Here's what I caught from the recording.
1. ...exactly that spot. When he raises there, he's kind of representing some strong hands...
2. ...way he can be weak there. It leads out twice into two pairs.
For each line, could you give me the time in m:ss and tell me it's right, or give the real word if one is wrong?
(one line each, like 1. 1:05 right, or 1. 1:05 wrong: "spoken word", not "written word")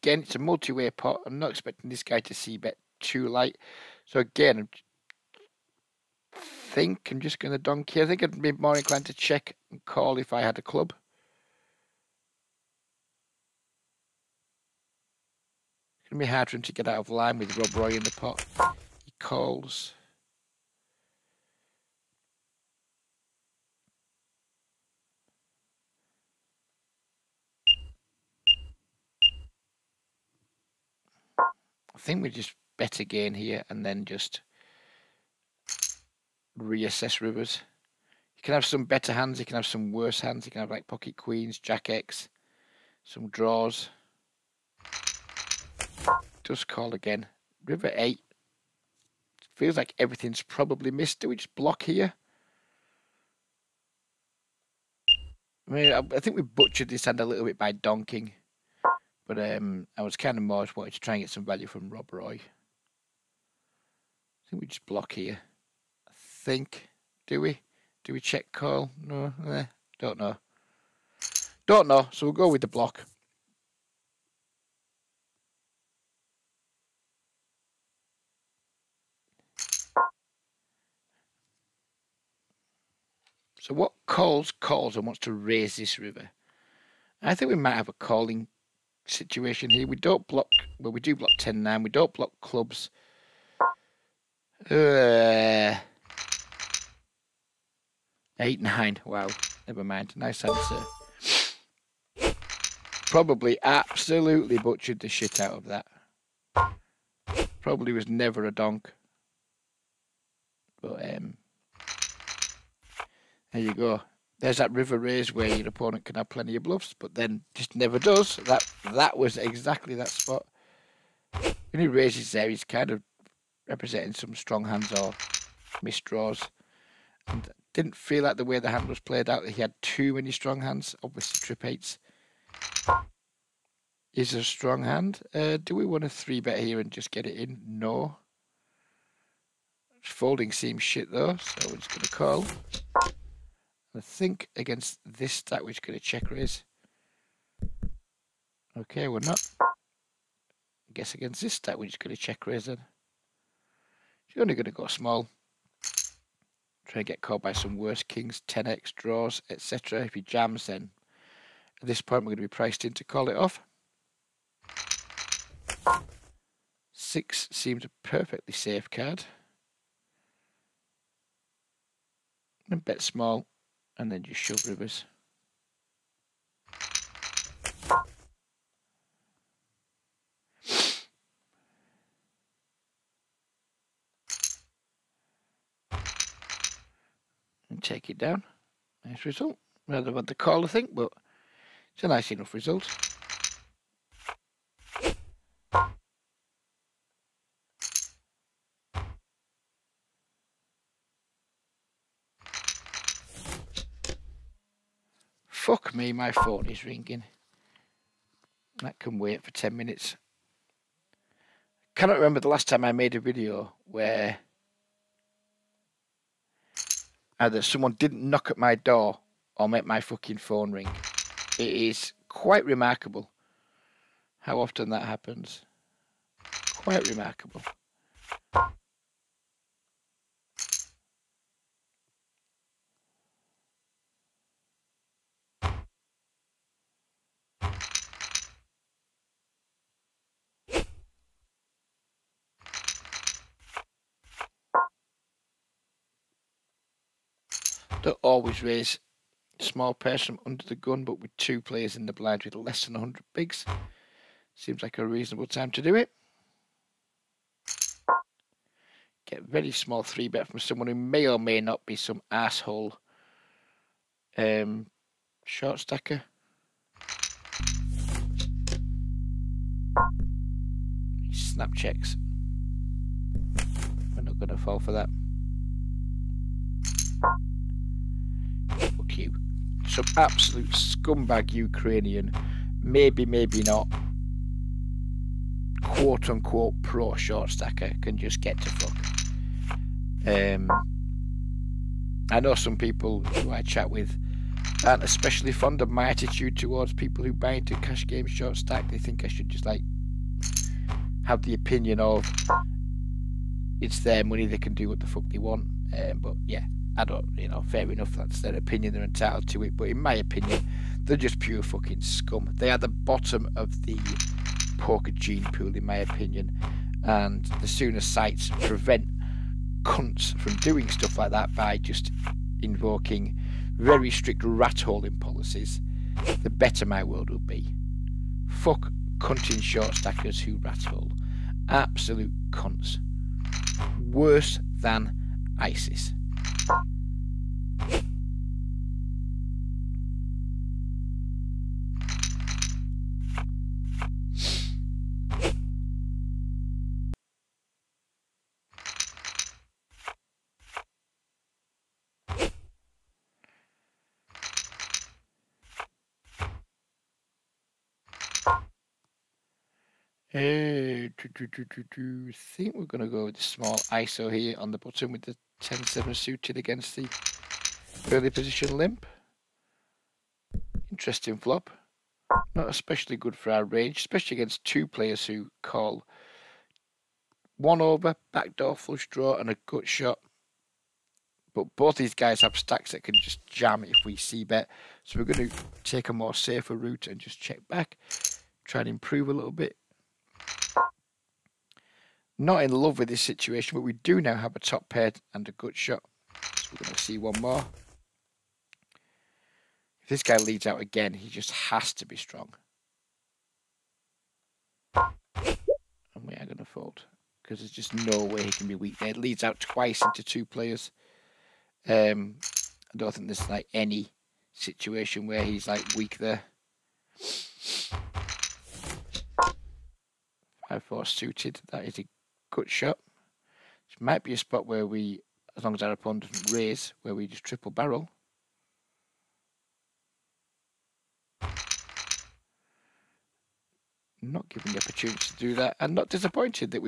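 1. 1:59 right
2. 6:48 wrong: "players", not "pairs".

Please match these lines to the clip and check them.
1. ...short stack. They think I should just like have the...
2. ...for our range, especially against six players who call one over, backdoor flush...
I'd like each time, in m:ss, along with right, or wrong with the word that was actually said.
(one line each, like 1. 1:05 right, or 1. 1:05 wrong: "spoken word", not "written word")
1. 4:58 right
2. 6:13 wrong: "two", not "six".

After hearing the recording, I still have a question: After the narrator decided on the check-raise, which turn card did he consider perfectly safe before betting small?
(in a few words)
6.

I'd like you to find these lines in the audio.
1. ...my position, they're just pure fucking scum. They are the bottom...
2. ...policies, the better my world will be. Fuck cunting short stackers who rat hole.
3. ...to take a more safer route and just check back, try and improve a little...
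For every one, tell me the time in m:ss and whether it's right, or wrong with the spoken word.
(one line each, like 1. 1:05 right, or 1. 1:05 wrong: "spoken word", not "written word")
1. 5:09 wrong: "opinion", not "position"
2. 5:25 right
3. 6:25 right.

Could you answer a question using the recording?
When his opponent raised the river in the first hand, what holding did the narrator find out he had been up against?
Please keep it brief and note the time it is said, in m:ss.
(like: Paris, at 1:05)
8 9, at 1:38.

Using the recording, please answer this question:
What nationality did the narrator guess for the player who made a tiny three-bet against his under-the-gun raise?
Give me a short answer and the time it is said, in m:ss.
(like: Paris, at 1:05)
Ukrainian, at 4:41.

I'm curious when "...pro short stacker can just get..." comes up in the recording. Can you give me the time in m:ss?
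4:46.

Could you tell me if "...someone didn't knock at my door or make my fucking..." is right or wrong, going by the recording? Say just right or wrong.
right.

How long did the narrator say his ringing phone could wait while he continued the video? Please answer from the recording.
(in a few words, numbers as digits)
10 minutes.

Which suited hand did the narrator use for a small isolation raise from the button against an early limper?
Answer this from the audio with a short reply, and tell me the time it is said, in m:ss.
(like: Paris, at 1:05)
10-7 suited, at 6:05.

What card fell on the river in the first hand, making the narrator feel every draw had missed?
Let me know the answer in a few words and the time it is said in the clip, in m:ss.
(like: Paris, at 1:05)
8, at 0:47.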